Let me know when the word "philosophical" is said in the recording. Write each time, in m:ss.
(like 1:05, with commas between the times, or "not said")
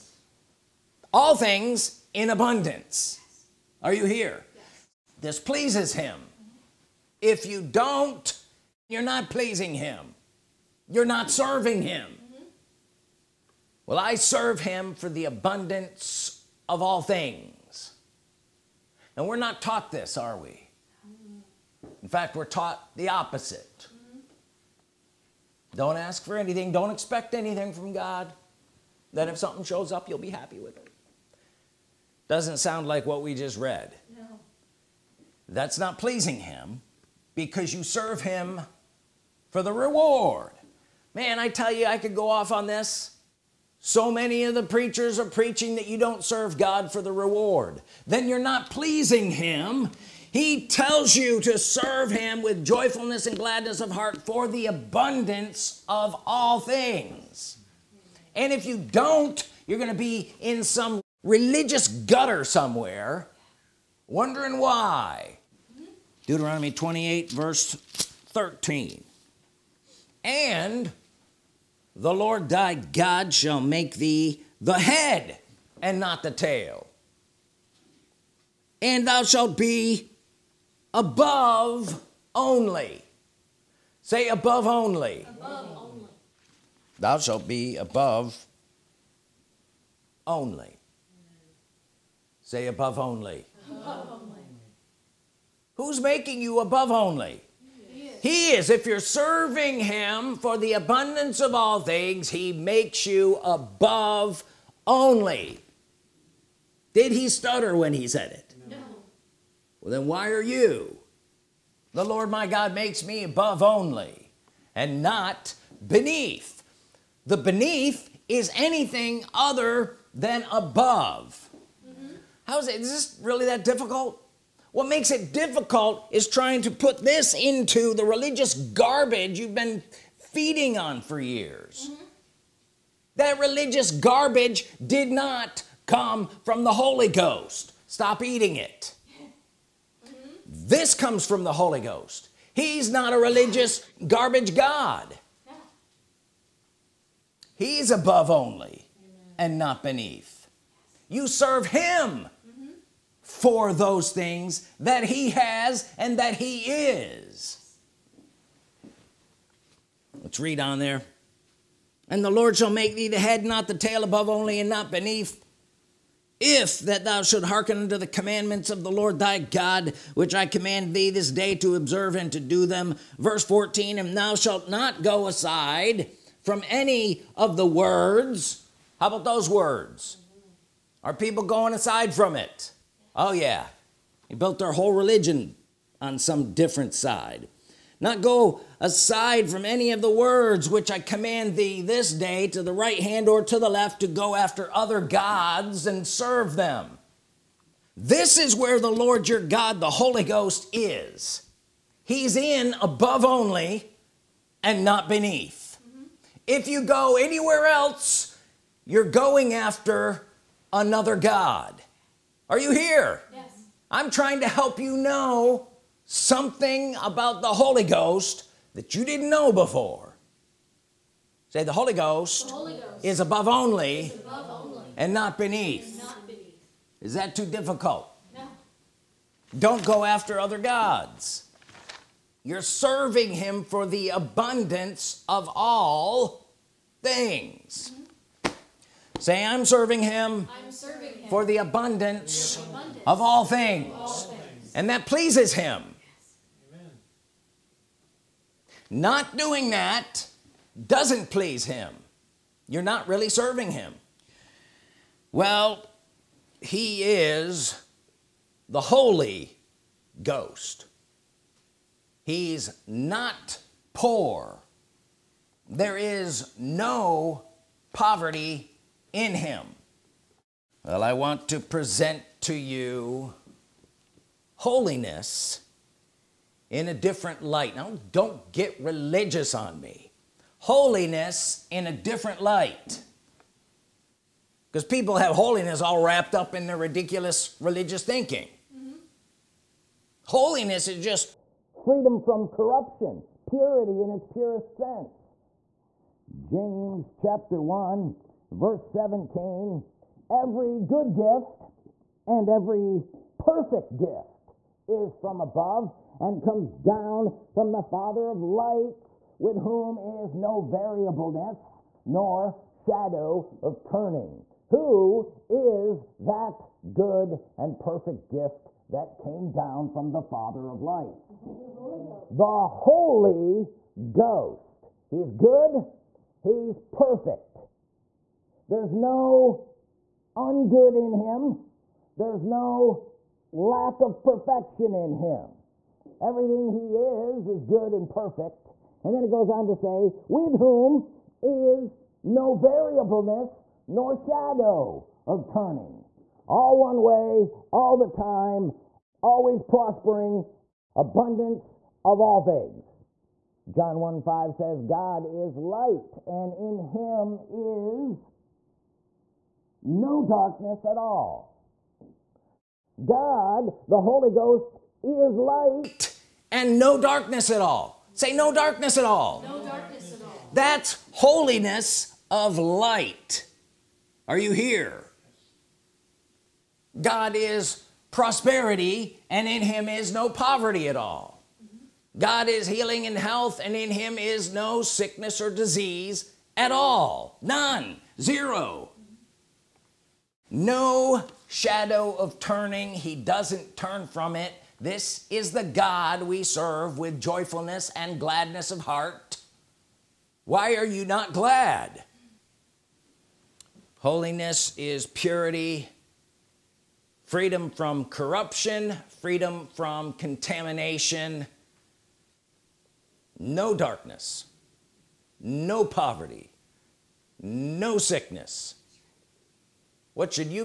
not said.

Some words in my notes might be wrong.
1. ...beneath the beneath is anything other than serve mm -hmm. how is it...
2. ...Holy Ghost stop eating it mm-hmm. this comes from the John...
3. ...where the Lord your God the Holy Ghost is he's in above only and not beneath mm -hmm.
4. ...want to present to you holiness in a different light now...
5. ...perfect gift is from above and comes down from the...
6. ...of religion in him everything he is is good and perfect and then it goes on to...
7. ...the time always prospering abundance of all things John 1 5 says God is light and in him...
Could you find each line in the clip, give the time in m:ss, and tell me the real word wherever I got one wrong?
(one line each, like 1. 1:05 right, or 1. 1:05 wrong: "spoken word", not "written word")
1. 1:55 wrong: "above", not "serve"
2. 2:16 wrong: "Holy", not "John"
3. 3:18 right
4. 4:31 right
5. 5:03 right
6. 5:34 wrong: "perfection", not "religion"
7. 5:47 right.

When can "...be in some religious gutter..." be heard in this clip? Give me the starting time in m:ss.
0:59.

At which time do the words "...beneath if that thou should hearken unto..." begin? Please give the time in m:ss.
2:44.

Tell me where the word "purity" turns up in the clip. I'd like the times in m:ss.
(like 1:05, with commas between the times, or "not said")
4:53, 6:45.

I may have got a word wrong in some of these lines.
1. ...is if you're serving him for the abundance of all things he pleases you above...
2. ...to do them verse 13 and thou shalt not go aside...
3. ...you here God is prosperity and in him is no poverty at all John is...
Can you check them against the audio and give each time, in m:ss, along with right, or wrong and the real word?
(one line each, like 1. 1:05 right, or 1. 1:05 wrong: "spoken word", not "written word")
1. 1:38 wrong: "makes", not "pleases"
2. 2:52 wrong: "14", not "13"
3. 6:14 wrong: "God", not "John".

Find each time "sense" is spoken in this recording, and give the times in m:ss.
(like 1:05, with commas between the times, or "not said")
4:54.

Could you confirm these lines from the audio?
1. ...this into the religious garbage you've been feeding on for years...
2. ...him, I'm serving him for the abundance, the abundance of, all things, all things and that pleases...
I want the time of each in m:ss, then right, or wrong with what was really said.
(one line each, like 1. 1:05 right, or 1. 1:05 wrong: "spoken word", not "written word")
1. 2:07 right
2. 4:00 right.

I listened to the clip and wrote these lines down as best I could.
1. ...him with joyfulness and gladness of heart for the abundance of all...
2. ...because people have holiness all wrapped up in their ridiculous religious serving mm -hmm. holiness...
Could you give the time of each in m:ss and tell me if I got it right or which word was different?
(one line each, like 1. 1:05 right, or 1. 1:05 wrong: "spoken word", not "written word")
1. 0:52 right
2. 4:44 wrong: "thinking", not "serving".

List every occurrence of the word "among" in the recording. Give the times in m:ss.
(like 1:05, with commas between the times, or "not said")
not said.